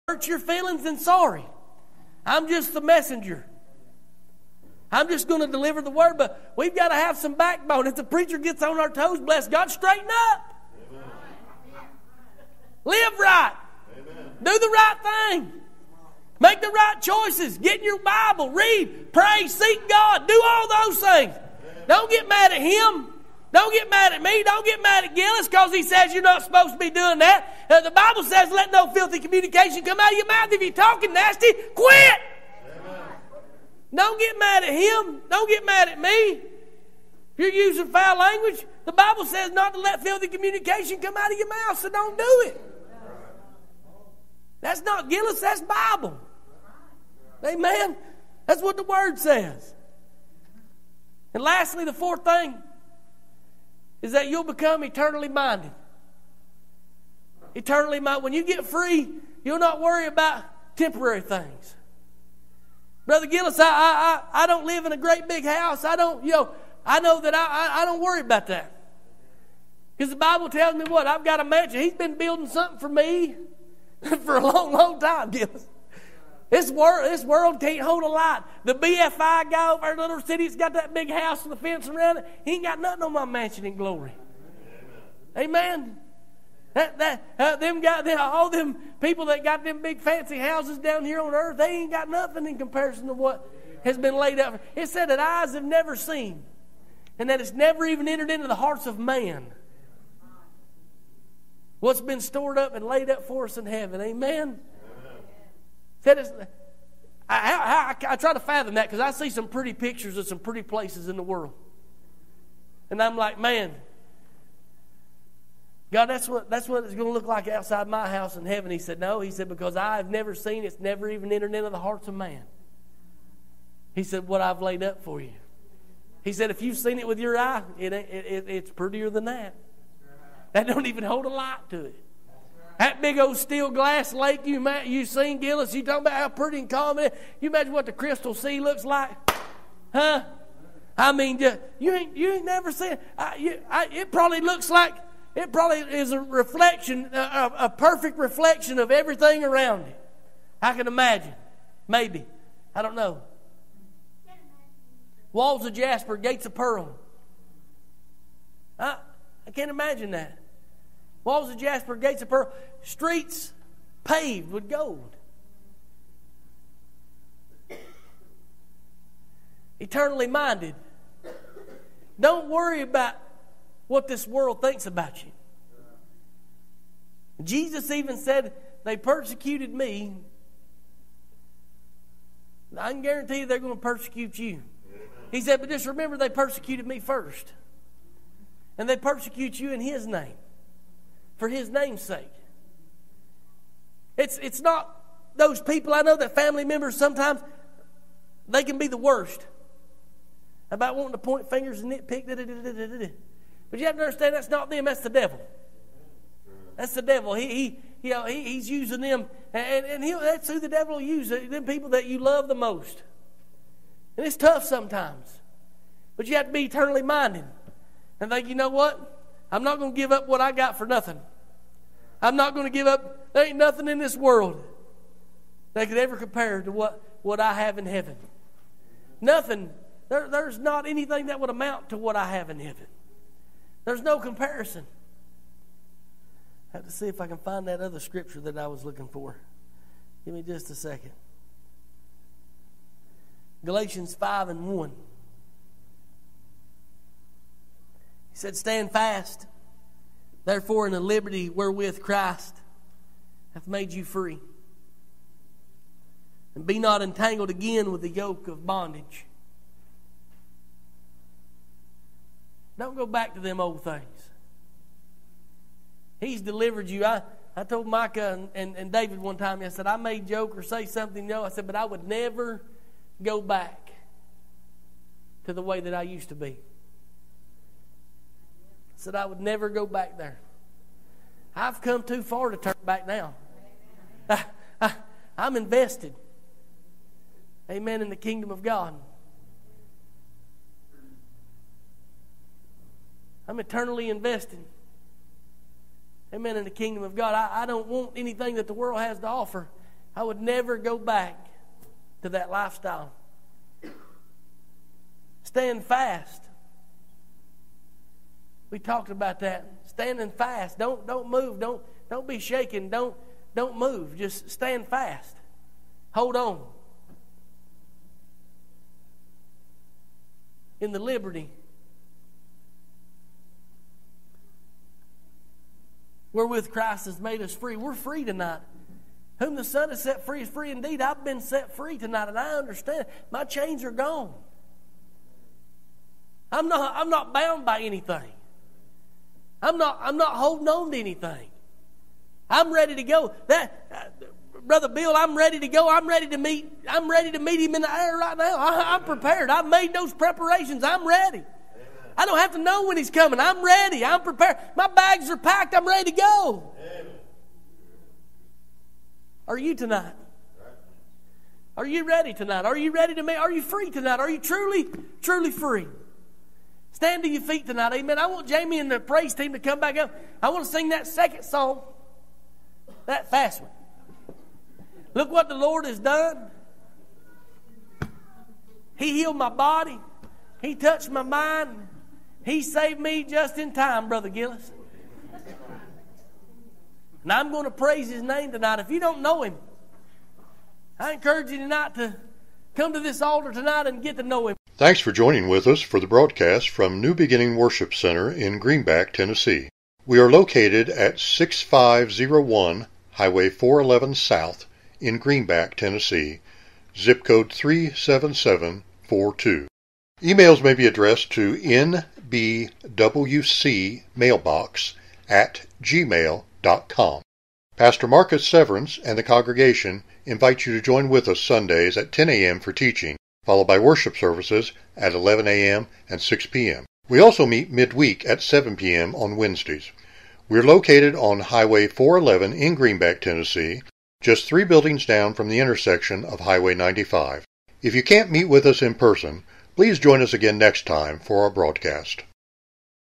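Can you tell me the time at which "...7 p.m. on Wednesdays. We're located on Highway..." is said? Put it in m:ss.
7:08.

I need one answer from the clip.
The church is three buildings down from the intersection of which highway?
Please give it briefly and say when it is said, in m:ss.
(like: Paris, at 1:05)
Highway 95, at 7:16.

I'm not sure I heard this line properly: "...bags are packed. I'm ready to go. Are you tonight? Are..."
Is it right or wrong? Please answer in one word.
right.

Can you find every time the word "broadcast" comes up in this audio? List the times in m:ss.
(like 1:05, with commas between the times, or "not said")
6:36, 7:21.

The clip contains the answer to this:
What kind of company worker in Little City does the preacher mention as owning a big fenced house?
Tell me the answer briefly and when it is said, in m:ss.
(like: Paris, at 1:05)
BFI guy, at 1:18.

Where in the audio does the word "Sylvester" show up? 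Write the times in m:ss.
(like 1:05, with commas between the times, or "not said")
not said.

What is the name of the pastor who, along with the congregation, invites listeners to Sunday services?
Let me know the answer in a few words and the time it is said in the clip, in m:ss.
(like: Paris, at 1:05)
Marcus Severance, at 6:58.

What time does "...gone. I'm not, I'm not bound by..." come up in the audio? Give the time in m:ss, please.
5:33.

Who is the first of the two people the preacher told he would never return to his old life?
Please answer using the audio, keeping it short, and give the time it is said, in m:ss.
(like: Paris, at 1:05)
Micah, at 4:27.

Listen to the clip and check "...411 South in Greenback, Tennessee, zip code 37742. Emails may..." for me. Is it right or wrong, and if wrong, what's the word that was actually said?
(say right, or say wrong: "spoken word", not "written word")
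right.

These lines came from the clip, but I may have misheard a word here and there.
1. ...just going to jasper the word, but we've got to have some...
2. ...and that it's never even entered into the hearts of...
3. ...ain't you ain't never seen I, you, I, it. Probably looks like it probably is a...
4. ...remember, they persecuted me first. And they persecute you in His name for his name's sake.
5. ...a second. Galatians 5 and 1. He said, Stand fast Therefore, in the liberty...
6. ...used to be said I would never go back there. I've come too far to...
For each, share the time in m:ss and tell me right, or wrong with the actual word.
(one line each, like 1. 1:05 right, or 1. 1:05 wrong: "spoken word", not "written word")
1. 0:05 wrong: "deliver", not "jasper"
2. 1:37 right
3. 2:21 right
4. 3:05 right
5. 4:00 right
6. 4:36 right.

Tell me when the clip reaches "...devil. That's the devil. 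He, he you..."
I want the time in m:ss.
3:25.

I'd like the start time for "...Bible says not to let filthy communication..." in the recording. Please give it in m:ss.
0:38.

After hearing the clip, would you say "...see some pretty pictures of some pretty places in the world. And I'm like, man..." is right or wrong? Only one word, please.
right.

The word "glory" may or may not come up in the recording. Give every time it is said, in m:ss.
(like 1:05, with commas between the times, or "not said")
1:23.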